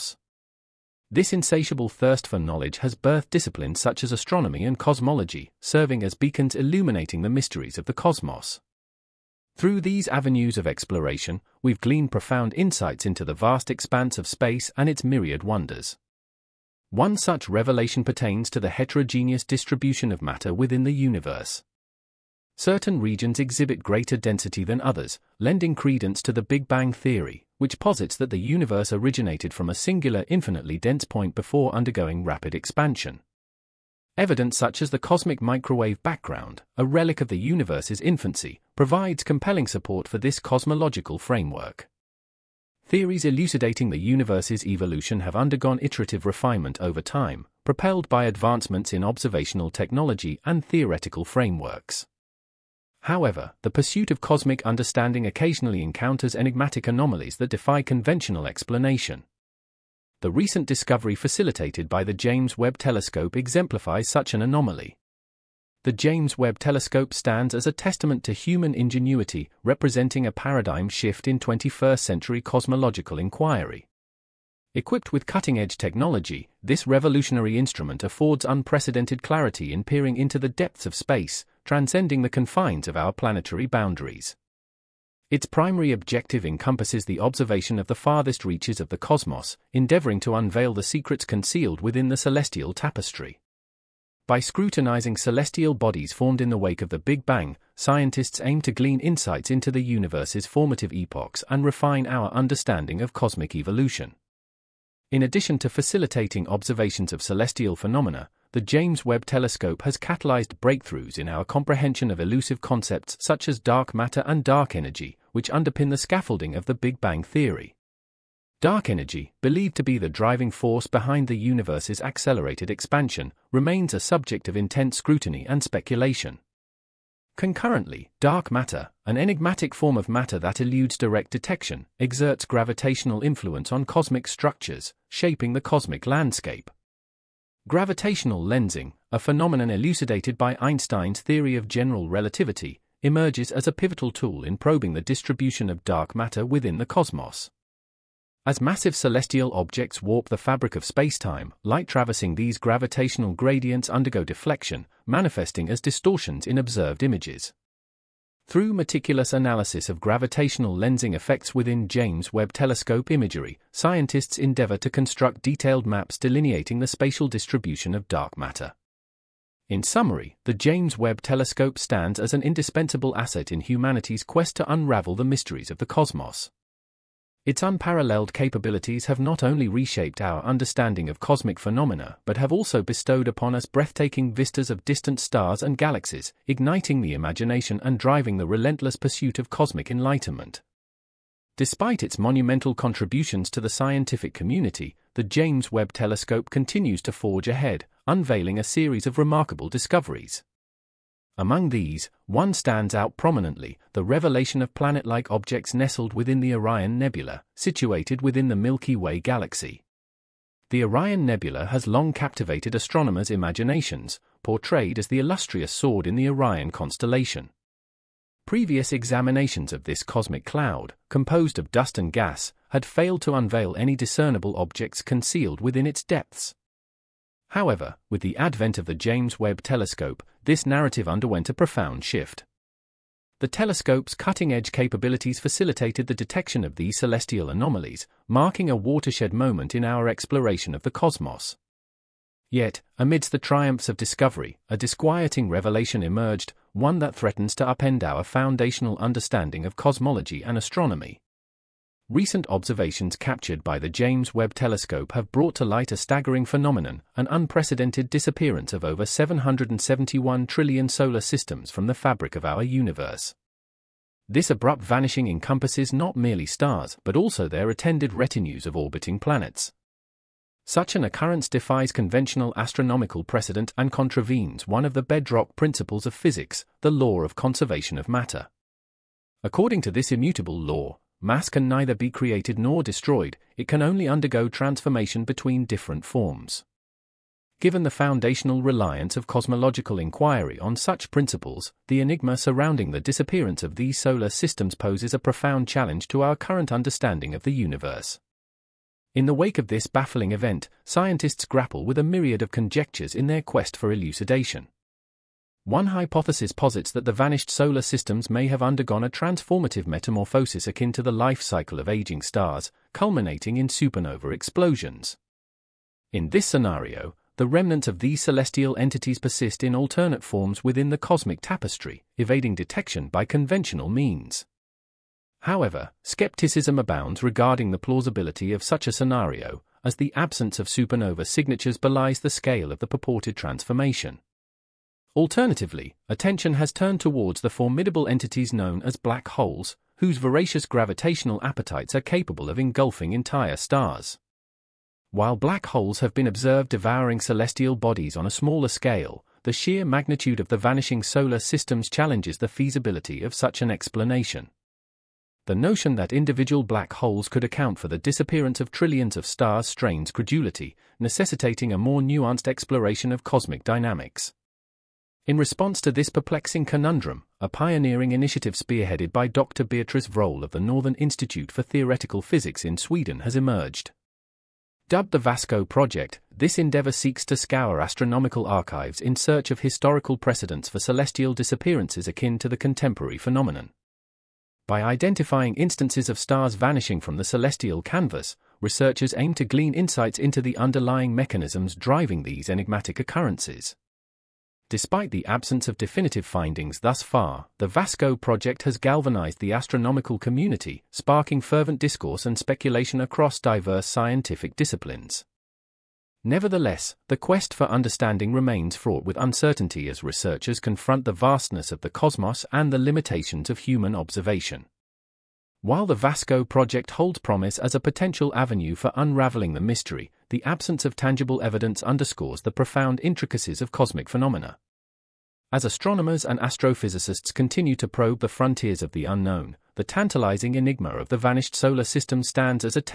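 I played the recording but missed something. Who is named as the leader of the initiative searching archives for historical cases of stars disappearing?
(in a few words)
Dr. Beatrice Vroll.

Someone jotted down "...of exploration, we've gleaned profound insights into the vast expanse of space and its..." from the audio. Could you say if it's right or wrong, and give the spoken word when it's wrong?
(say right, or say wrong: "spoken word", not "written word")
right.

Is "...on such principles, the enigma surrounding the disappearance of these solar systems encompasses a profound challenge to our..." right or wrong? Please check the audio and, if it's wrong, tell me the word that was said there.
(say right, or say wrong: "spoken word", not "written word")
wrong: "poses", not "encompasses".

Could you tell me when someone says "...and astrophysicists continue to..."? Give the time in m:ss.
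7:06.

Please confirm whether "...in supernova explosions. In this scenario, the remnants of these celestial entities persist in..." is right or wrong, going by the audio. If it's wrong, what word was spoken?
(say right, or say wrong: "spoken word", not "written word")
right.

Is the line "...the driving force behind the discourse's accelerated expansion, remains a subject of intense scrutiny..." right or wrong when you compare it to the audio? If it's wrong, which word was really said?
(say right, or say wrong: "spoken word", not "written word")
wrong: "universe", not "discourse".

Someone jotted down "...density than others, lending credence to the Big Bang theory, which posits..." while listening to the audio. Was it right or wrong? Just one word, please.
right.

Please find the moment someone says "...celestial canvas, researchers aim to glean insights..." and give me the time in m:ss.
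6:27.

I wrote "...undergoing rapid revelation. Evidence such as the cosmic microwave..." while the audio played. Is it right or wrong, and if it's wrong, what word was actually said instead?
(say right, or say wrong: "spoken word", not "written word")
wrong: "expansion", not "revelation".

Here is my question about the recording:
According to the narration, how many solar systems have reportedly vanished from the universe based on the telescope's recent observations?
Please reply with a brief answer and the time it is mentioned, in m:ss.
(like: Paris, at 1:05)
771 trillion, at 4:19.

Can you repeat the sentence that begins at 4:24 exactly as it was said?
This abrupt vanishing encompasses not merely stars but also their attended retinues of orbiting planets.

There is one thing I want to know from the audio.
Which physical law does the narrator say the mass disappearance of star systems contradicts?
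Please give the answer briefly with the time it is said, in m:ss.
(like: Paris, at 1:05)
conservation of matter, at 4:37.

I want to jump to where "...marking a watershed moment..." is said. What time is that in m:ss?
3:58.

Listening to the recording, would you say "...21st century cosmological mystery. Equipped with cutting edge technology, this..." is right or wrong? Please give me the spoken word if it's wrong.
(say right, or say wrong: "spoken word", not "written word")
wrong: "inquiry", not "mystery".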